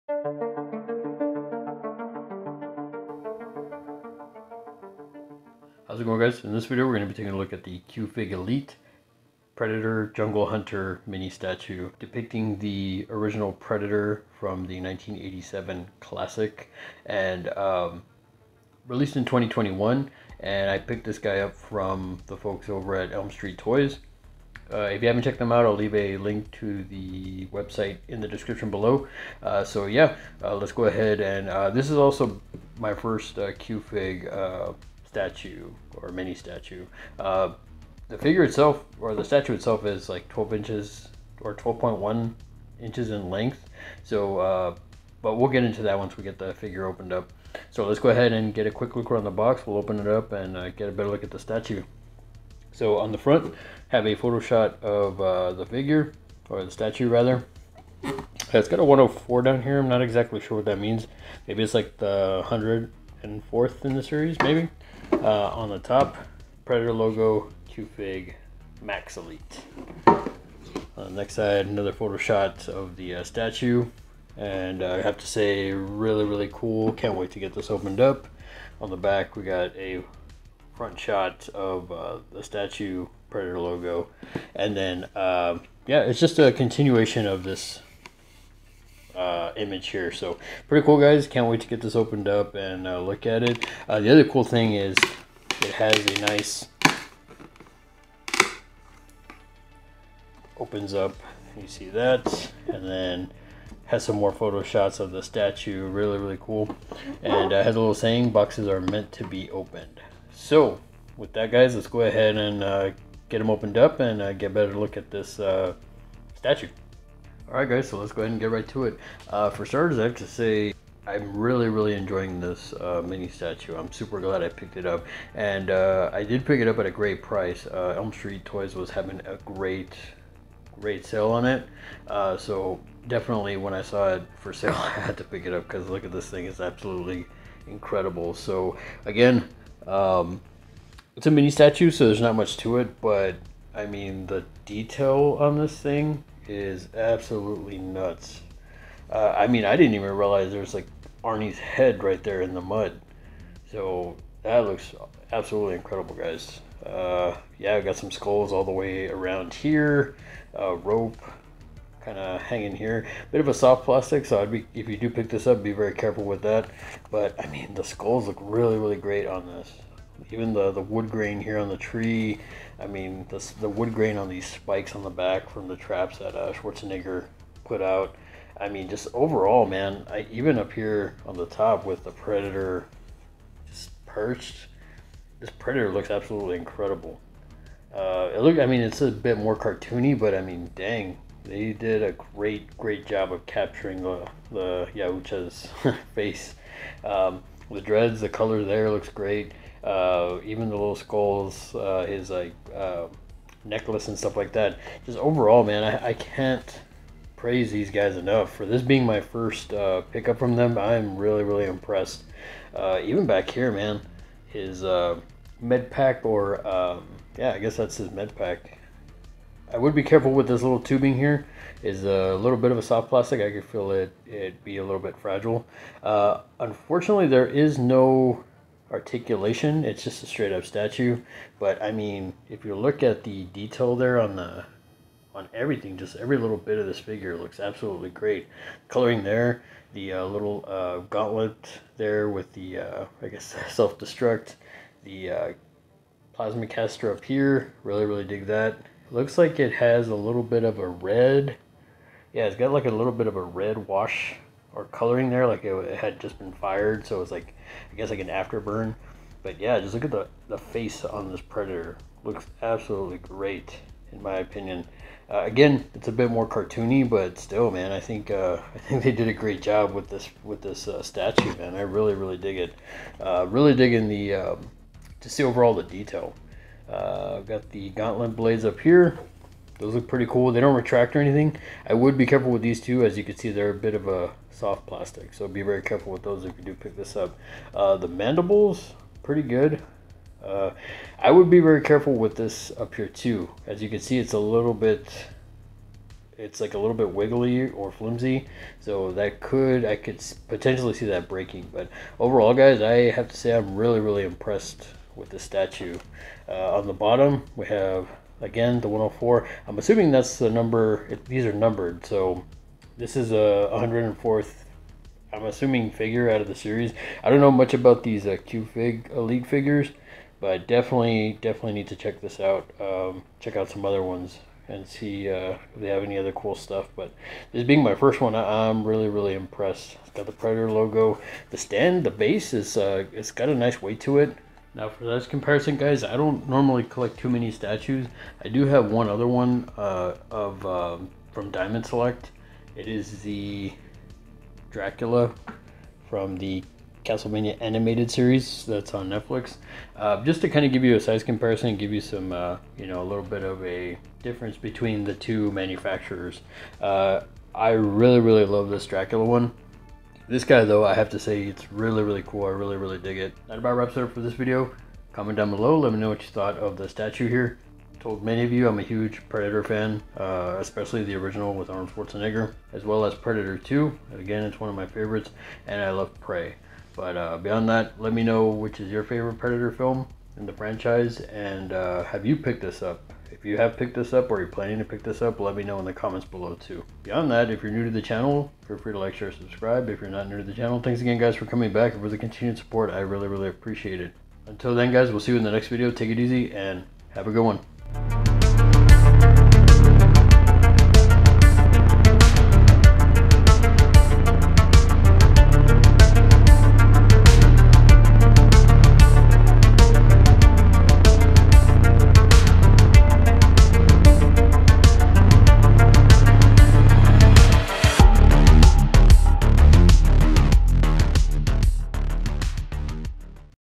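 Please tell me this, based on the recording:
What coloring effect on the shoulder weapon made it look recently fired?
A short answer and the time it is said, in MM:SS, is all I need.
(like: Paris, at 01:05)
red wash, at 04:13.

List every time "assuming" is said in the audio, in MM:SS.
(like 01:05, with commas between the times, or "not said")
05:09, 05:15.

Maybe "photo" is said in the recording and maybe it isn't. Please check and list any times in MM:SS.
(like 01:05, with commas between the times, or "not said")
00:54, 01:11, 01:44.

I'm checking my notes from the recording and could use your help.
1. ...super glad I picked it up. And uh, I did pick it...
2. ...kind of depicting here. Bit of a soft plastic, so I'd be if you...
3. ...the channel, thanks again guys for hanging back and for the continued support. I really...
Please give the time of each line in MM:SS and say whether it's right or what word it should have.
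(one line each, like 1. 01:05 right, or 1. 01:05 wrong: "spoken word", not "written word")
1. 02:03 right
2. 02:42 wrong: "hanging", not "depicting"
3. 06:30 wrong: "coming", not "hanging".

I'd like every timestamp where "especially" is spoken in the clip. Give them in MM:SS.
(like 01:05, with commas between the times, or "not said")
06:10.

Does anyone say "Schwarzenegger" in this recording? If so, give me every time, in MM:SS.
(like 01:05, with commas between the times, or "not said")
02:56, 06:11.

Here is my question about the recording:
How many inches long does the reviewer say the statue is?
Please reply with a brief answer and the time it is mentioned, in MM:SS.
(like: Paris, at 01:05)
12.1 inches, at 00:41.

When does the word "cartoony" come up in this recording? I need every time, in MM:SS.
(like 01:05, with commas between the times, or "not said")
03:09, 04:26.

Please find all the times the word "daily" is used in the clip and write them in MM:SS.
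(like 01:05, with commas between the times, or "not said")
not said.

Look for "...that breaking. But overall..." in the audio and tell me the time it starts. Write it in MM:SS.
05:01.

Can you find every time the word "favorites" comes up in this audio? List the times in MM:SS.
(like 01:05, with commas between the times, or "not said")
06:14, 06:19.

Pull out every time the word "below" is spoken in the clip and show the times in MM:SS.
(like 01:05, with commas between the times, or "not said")
00:28, 06:05, 06:26.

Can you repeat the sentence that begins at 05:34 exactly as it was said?
Now for this comparison, guys, I don't normally collect too many statues.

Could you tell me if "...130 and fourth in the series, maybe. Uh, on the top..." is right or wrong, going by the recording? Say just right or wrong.
wrong.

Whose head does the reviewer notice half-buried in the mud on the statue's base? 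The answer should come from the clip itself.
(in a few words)
Arnie's.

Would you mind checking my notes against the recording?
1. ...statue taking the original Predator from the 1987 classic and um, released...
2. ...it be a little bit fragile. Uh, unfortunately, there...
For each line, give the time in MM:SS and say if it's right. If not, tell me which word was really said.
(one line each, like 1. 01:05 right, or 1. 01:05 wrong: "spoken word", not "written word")
1. 00:11 wrong: "depicting", not "taking"
2. 03:44 right.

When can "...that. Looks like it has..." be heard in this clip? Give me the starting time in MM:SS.
04:08.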